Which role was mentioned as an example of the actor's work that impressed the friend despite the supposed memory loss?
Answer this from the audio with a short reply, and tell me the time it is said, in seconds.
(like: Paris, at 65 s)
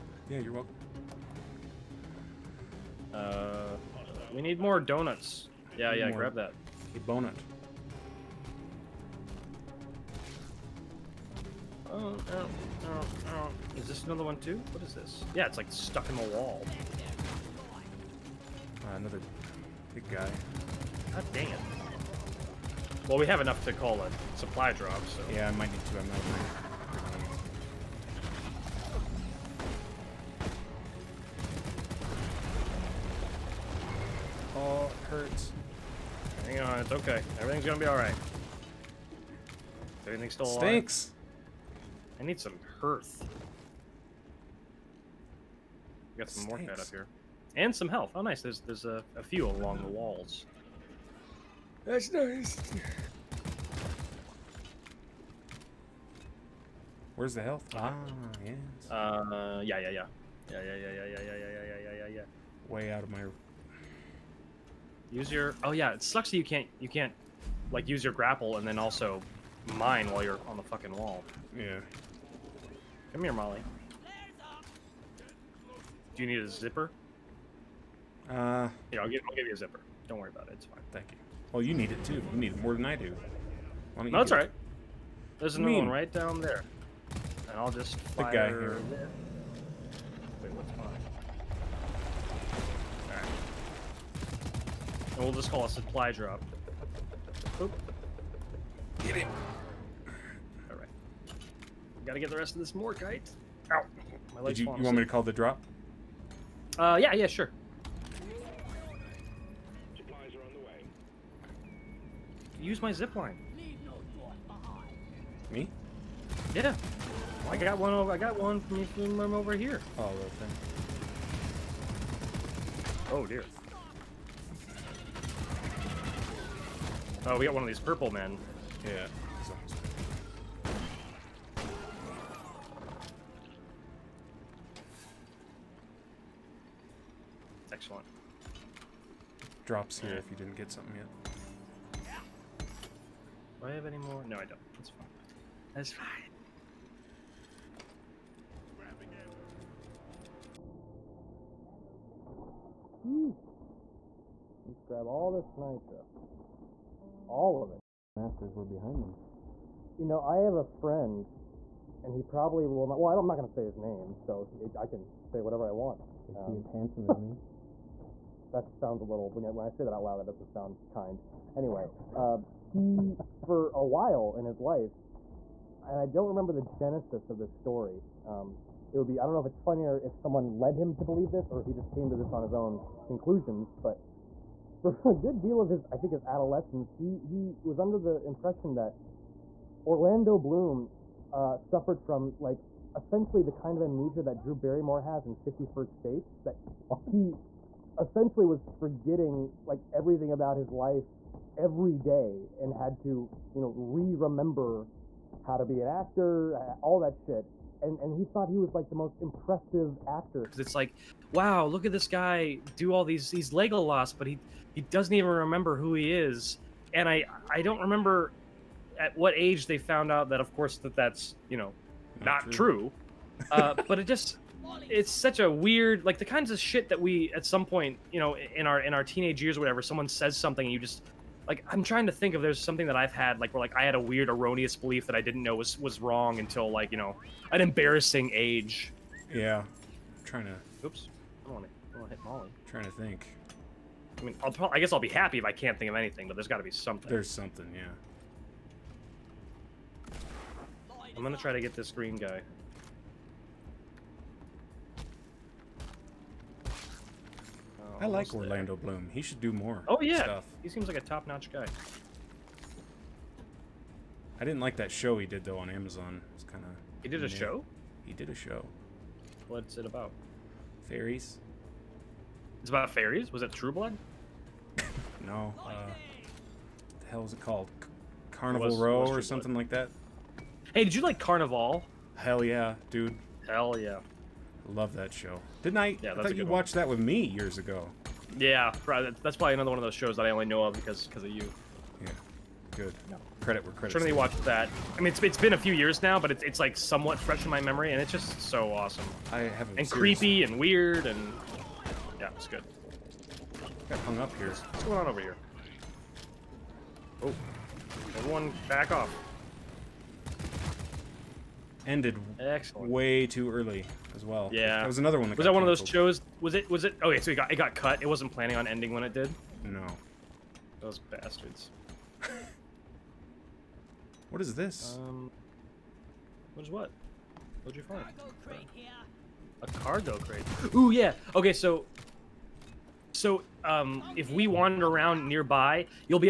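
Legolas, at 213 s.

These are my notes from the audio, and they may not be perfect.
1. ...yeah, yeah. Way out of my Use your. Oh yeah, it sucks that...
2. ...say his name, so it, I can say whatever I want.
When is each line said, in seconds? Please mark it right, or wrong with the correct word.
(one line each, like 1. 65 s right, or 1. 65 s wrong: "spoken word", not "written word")
1. 62 s right
2. 163 s right.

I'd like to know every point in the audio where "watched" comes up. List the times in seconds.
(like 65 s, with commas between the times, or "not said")
286 s, 294 s.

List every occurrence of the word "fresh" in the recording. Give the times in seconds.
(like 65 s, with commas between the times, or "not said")
297 s.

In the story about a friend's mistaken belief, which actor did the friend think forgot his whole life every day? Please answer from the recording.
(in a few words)
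Orlando Bloom.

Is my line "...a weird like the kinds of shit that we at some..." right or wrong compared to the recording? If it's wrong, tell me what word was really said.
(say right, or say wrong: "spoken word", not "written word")
right.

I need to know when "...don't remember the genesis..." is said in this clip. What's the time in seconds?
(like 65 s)
176 s.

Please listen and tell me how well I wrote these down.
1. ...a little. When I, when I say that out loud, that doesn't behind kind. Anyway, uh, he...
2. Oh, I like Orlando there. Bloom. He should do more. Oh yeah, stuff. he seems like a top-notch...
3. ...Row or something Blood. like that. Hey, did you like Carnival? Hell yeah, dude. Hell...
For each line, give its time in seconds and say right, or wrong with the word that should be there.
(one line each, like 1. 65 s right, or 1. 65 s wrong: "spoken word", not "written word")
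1. 169 s wrong: "sound", not "behind"
2. 256 s right
3. 278 s right.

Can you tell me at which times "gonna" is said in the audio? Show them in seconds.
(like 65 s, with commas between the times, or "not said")
37 s, 251 s.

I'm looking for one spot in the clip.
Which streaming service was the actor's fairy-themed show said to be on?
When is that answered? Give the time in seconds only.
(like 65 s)
265 s.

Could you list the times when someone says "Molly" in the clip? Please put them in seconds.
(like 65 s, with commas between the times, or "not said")
73 s, 242 s.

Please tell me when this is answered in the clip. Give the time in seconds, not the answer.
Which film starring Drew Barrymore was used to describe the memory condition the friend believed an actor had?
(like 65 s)
195 s.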